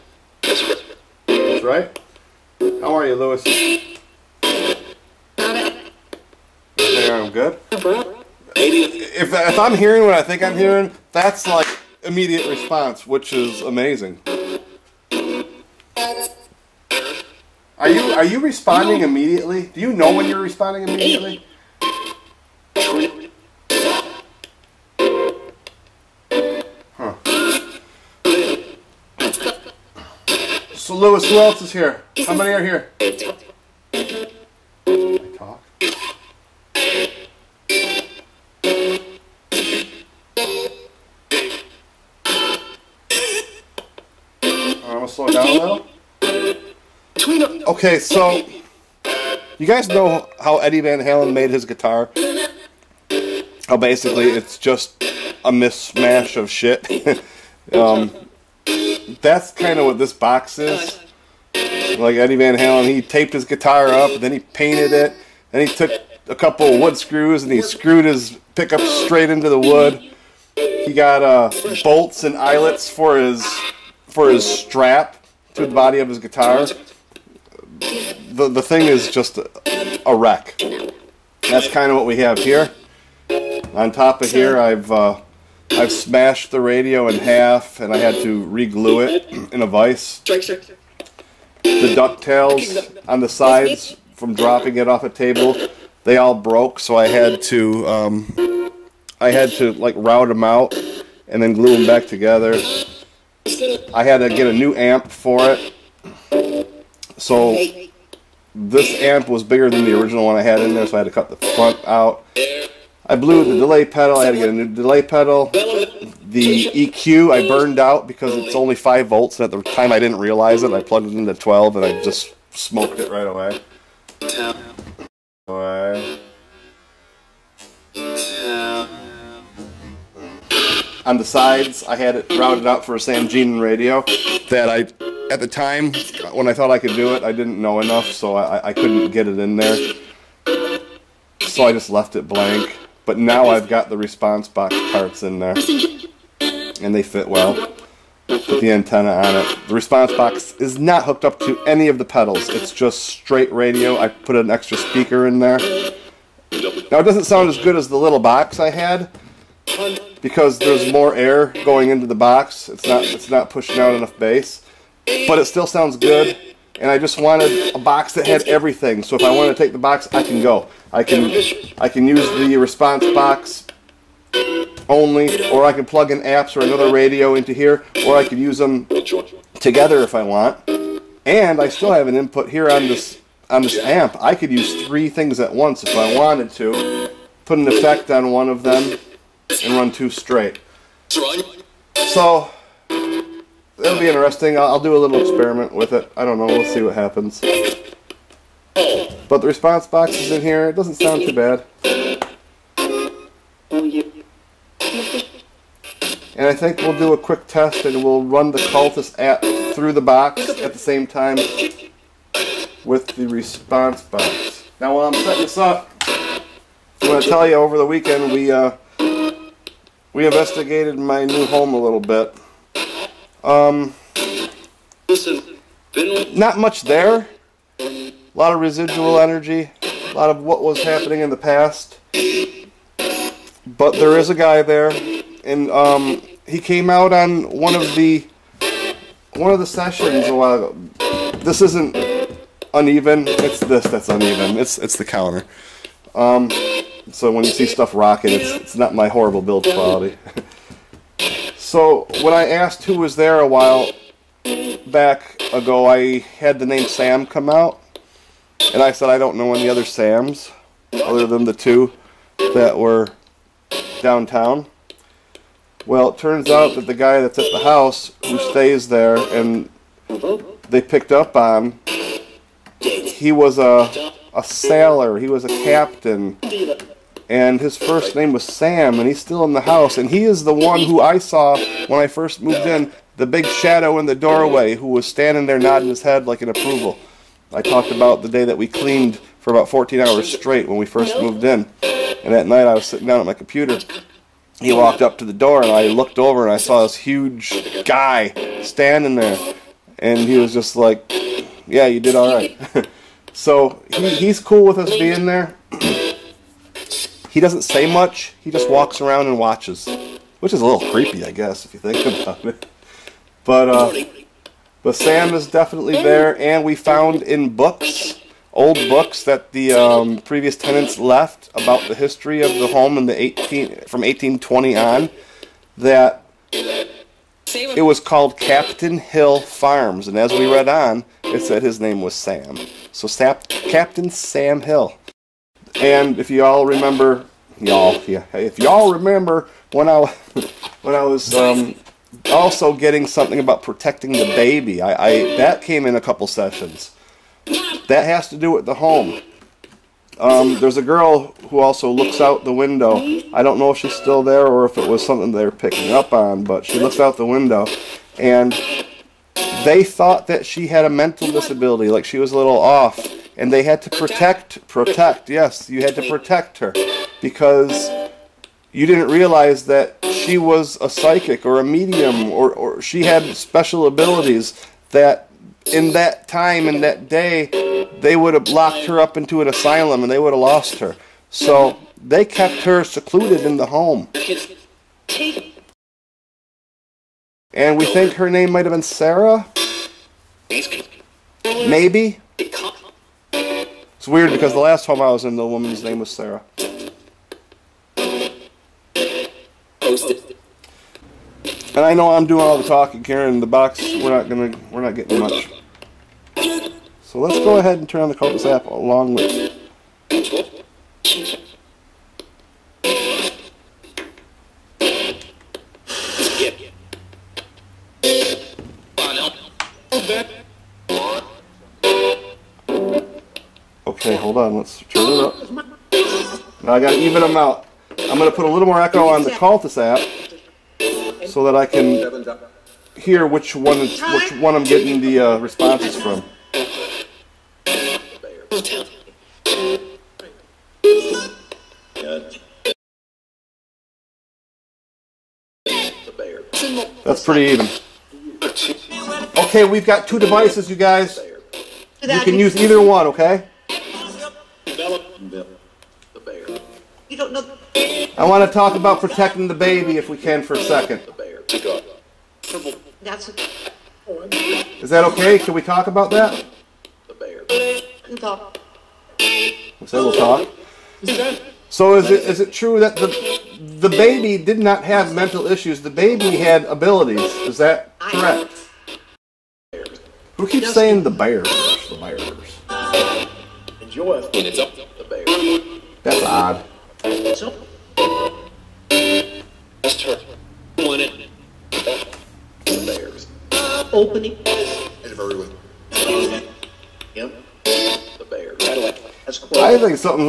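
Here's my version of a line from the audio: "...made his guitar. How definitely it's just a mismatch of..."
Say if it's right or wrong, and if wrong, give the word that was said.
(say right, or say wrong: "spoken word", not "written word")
wrong: "basically", not "definitely".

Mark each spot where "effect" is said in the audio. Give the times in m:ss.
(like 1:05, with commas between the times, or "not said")
3:07.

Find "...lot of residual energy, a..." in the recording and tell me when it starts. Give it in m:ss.
3:48.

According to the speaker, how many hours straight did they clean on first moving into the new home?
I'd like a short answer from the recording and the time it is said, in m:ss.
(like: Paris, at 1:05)
14, at 4:49.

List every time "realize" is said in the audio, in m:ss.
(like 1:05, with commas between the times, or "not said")
2:00, 6:09.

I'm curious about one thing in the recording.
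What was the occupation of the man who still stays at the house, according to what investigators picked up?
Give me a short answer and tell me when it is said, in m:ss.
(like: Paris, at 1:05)
sailor, at 4:34.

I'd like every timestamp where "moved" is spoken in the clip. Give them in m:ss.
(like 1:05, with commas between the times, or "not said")
4:42, 4:51.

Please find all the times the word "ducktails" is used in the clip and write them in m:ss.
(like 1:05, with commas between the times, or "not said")
1:31.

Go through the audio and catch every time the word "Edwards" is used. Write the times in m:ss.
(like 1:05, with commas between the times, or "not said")
not said.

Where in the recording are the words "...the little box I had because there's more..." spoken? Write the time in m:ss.
2:37.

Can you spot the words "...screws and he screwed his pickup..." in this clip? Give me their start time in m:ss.
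1:06.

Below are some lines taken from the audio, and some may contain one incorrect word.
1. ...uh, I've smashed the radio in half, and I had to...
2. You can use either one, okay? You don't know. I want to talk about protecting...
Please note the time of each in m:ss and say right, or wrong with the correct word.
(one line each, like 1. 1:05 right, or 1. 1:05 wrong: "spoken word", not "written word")
1. 1:24 right
2. 7:32 right.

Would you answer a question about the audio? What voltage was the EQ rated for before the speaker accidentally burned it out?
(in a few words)
5 volts.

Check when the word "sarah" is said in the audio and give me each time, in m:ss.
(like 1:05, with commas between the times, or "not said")
6:28, 6:36.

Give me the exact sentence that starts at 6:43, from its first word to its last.
The box we're not gonna we're not getting much.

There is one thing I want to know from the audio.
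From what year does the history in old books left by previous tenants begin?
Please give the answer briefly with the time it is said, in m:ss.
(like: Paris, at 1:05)
1820, at 5:24.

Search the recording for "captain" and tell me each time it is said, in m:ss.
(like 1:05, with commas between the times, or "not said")
4:35, 5:28, 5:33.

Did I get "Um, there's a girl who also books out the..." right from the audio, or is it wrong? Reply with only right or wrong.
wrong.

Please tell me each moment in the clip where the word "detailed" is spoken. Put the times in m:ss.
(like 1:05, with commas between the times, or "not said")
not said.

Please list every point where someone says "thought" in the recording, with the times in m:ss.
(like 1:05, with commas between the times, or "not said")
2:16, 5:59.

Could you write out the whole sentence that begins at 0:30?
So Lewis, who else is here?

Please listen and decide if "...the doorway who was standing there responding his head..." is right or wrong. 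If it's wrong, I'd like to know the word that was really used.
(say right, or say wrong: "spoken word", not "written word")
wrong: "nodding", not "responding".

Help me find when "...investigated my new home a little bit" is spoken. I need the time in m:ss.
3:40.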